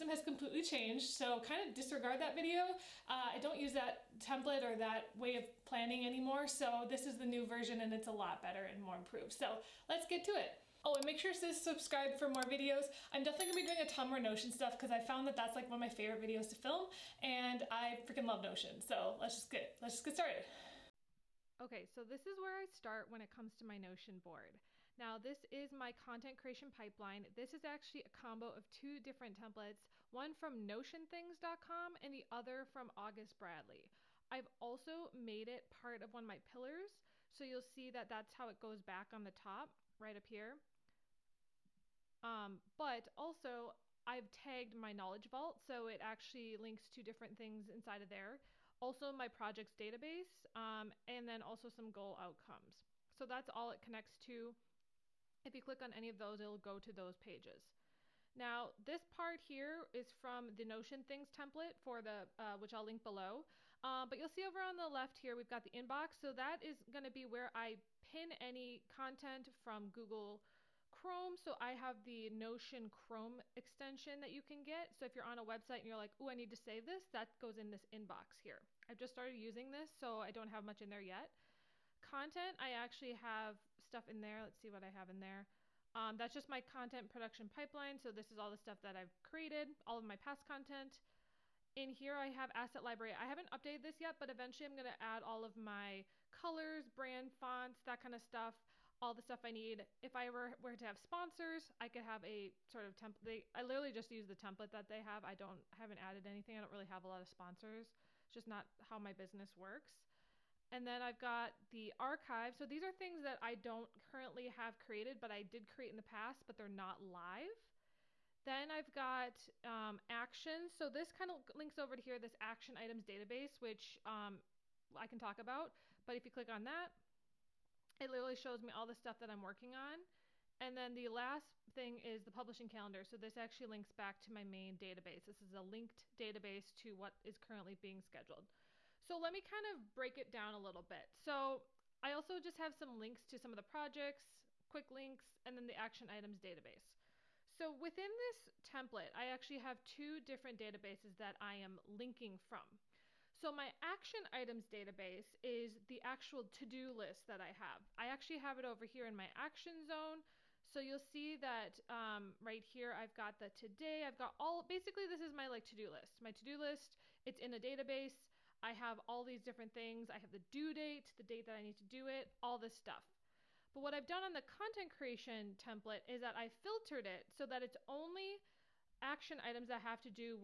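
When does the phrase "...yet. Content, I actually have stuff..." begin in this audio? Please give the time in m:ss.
1:21.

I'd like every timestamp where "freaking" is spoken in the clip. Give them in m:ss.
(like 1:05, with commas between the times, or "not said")
0:18.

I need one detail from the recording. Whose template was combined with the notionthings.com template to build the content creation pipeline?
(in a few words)
August Bradley.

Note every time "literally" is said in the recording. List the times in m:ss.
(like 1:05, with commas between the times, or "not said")
1:43, 2:08.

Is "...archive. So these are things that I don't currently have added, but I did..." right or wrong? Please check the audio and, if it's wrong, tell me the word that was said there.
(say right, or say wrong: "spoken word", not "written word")
wrong: "created", not "added".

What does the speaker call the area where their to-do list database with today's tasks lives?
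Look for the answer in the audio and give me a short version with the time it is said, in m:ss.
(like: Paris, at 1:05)
action zone, at 2:39.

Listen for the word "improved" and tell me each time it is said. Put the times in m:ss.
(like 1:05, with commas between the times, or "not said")
0:08.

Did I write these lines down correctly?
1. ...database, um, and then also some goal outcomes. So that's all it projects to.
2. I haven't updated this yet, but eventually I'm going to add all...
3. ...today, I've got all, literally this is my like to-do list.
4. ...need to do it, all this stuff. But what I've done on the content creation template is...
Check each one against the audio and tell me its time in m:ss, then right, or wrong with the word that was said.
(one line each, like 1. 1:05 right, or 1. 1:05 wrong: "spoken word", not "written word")
1. 0:49 wrong: "connects", not "projects"
2. 1:33 right
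3. 2:43 wrong: "basically", not "literally"
4. 2:51 right.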